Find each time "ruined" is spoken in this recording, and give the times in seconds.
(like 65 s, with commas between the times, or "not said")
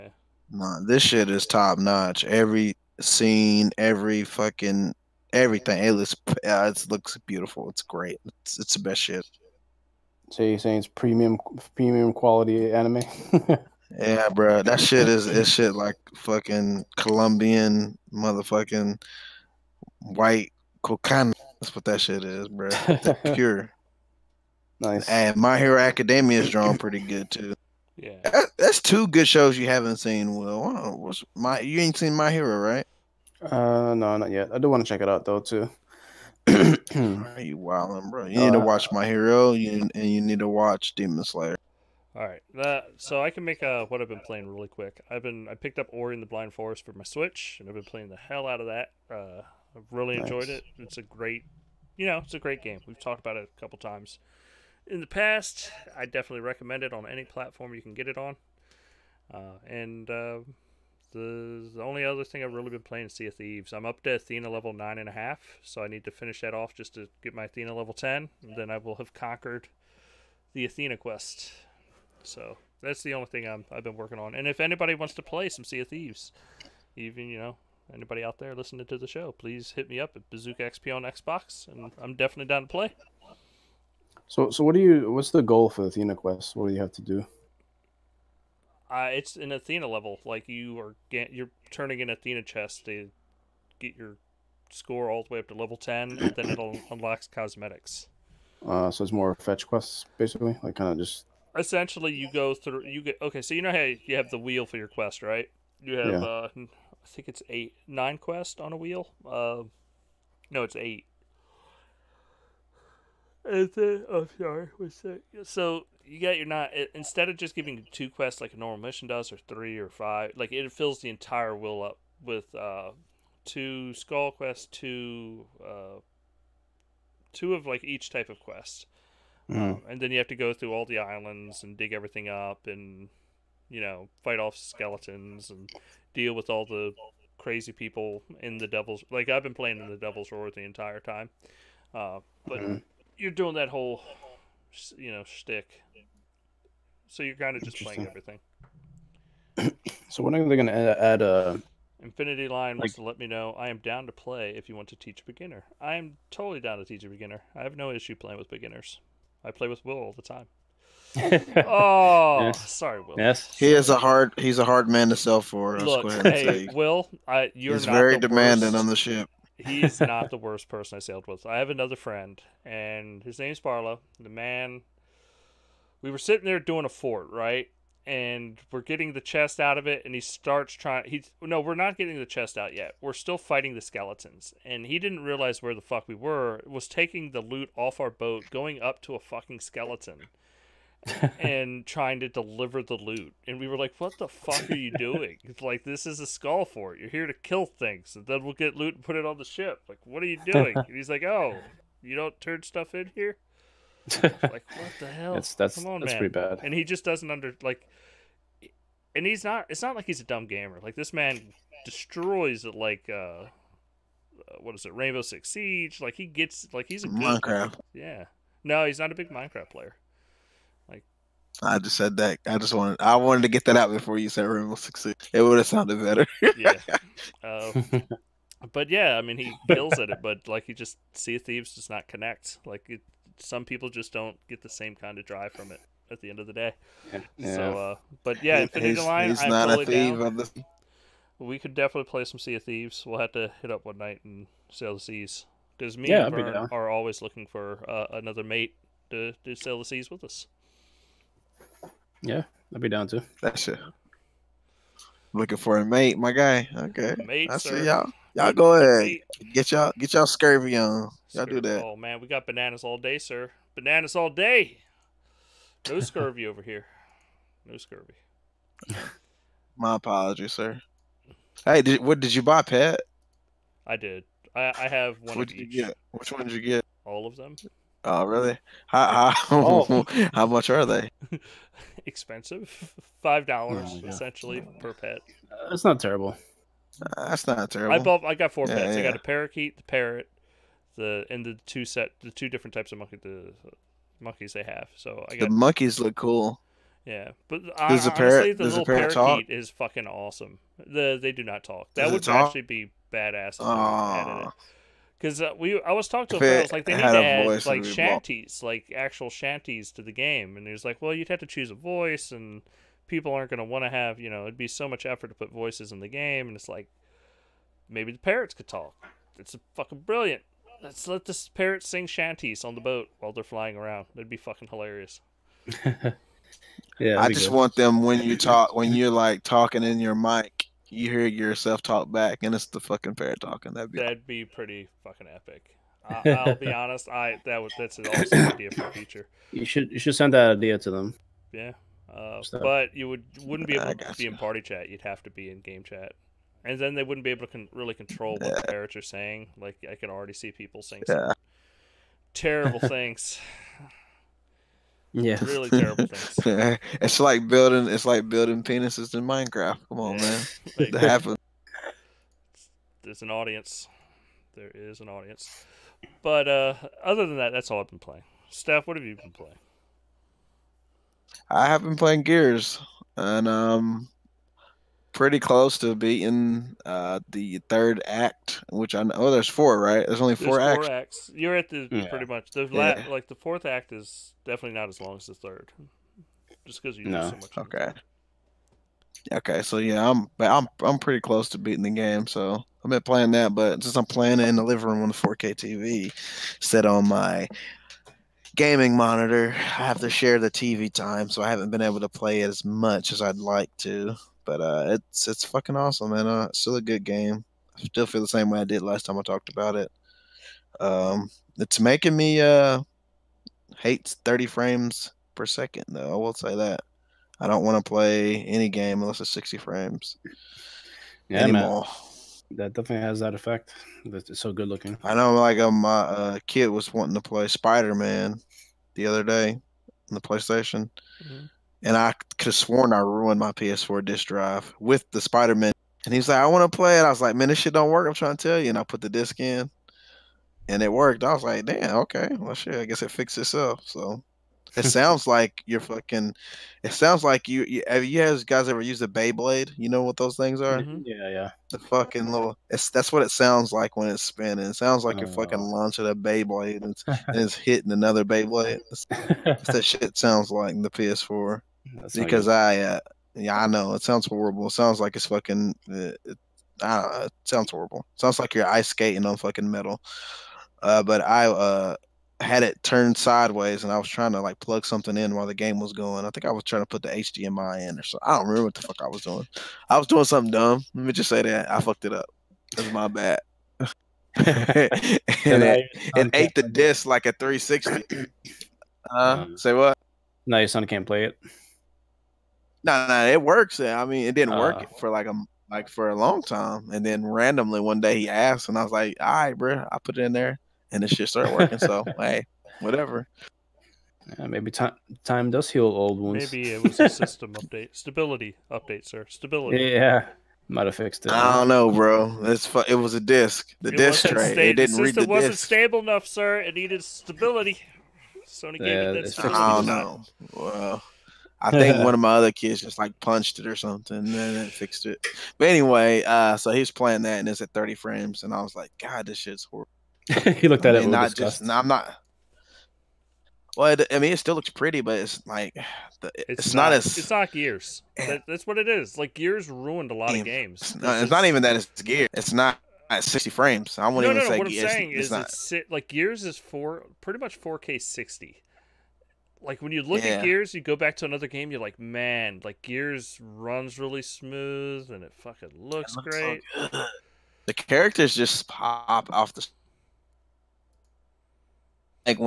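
432 s, 539 s.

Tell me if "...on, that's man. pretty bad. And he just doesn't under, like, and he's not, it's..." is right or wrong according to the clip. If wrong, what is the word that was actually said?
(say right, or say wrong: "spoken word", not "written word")
right.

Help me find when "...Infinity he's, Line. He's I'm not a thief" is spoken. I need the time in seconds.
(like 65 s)
238 s.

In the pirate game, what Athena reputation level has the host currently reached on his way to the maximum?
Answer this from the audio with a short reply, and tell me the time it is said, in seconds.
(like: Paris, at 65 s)
9.5, at 64 s.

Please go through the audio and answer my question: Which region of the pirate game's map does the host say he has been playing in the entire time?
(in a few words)
Devil's Roar.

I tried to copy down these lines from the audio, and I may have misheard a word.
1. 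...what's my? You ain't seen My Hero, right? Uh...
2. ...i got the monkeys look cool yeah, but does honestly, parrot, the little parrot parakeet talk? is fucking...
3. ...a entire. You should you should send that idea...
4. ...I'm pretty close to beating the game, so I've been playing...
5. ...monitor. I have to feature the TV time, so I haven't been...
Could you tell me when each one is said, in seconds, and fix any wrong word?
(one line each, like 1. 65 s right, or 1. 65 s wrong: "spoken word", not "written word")
1. 30 s right
2. 295 s right
3. 338 s wrong: "feature", not "entire"
4. 390 s right
5. 398 s wrong: "share", not "feature".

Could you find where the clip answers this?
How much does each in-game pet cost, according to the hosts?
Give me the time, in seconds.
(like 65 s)
283 s.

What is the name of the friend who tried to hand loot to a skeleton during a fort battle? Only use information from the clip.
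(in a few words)
Barlow.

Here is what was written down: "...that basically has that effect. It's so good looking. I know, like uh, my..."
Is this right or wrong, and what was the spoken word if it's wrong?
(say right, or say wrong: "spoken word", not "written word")
wrong: "definitely", not "basically".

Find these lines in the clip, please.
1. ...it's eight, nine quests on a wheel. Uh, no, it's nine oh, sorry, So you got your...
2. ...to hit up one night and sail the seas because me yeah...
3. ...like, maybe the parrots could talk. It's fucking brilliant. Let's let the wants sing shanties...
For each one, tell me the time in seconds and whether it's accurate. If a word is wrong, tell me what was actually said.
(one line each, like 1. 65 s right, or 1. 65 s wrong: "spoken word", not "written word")
1. 107 s wrong: "eight", not "nine"
2. 243 s right
3. 316 s wrong: "parrots", not "wants".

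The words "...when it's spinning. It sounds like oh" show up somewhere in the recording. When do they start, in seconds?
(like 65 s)
453 s.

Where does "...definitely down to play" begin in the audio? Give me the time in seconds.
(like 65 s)
82 s.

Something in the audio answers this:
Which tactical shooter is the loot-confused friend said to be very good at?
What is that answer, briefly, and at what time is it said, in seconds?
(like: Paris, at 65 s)
Rainbow Six Siege, at 214 s.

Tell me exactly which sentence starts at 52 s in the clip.
We've talked about it a couple times in the past.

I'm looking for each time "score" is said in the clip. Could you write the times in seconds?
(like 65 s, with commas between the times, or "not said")
94 s.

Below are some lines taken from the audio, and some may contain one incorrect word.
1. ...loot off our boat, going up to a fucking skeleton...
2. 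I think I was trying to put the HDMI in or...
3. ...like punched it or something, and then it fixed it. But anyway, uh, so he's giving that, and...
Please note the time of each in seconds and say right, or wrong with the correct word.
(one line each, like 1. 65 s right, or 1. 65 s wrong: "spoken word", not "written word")
1. 187 s right
2. 476 s right
3. 522 s wrong: "playing", not "giving".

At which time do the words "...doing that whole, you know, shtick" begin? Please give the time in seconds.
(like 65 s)
143 s.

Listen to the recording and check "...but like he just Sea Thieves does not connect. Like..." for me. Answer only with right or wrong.
right.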